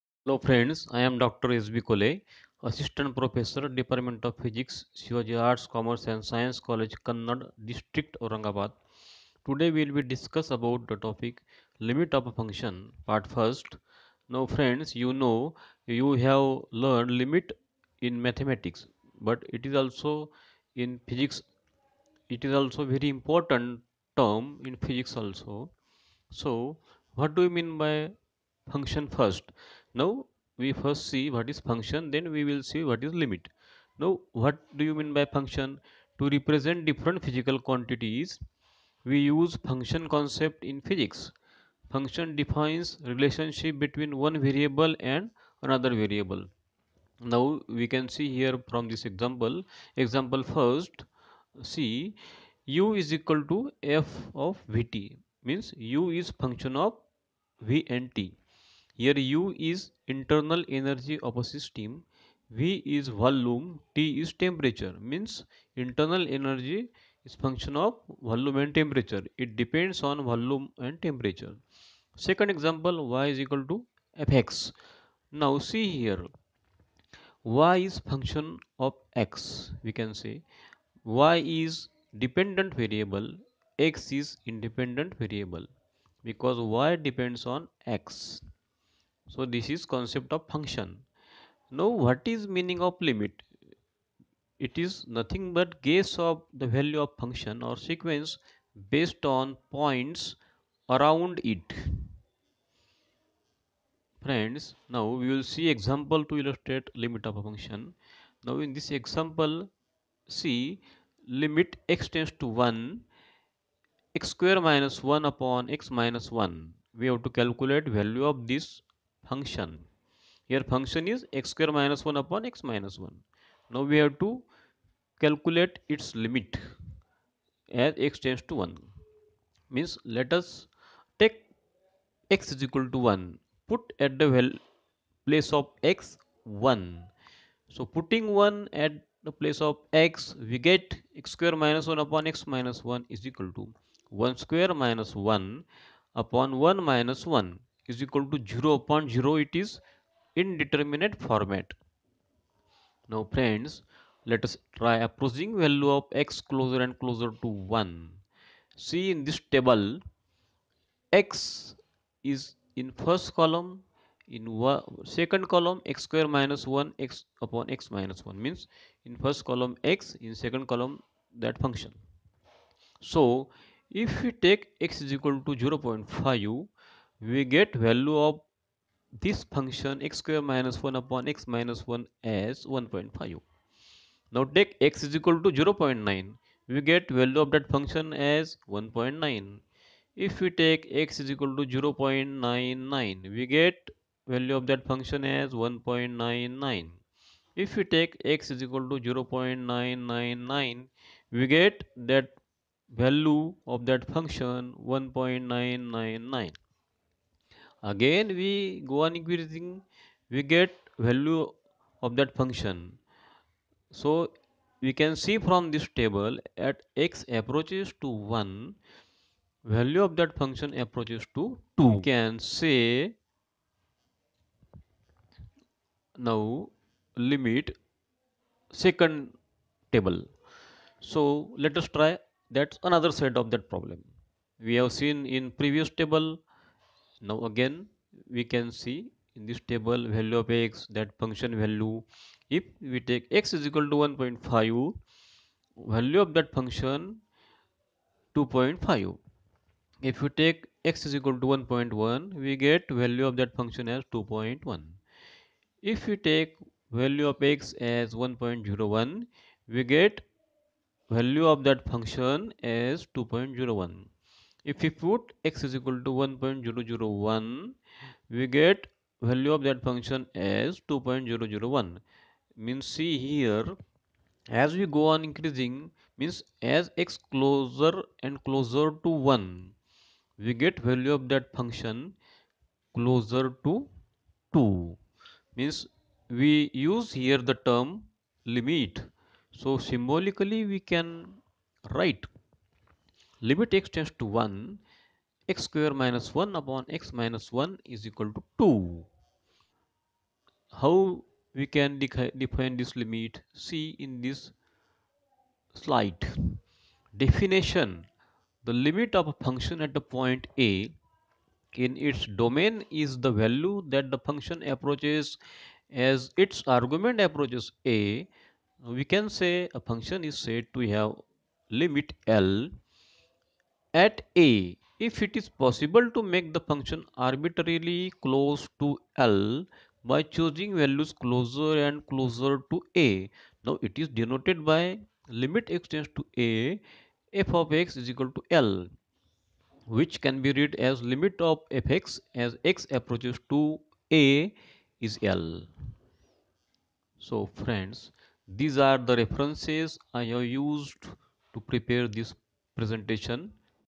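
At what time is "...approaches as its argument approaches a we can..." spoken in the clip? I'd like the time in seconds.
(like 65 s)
314 s.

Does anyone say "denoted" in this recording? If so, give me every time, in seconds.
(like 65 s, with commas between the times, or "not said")
334 s.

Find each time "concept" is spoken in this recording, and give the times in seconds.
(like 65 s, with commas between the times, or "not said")
40 s, 89 s.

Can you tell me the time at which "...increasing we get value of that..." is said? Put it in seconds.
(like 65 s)
209 s.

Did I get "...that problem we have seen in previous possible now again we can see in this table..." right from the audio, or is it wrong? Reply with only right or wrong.
wrong.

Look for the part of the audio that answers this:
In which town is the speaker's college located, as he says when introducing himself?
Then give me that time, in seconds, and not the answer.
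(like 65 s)
7 s.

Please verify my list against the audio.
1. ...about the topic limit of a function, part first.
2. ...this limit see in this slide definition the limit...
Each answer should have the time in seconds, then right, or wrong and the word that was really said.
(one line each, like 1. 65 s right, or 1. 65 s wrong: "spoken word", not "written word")
1. 10 s right
2. 302 s right.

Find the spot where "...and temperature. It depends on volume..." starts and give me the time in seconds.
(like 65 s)
68 s.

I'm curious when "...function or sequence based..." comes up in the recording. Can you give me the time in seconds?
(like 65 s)
97 s.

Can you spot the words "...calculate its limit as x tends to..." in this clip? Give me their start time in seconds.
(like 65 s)
125 s.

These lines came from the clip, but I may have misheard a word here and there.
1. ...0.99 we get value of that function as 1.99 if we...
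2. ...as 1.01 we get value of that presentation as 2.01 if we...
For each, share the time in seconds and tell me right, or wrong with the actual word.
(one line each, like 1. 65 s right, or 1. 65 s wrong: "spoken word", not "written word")
1. 191 s right
2. 257 s wrong: "function", not "presentation".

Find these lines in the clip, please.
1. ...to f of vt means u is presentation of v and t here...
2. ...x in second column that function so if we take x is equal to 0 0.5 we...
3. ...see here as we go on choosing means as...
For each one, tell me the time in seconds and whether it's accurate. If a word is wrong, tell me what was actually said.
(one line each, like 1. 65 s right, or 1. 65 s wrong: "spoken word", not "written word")
1. 53 s wrong: "function", not "presentation"
2. 169 s right
3. 272 s wrong: "increasing", not "choosing".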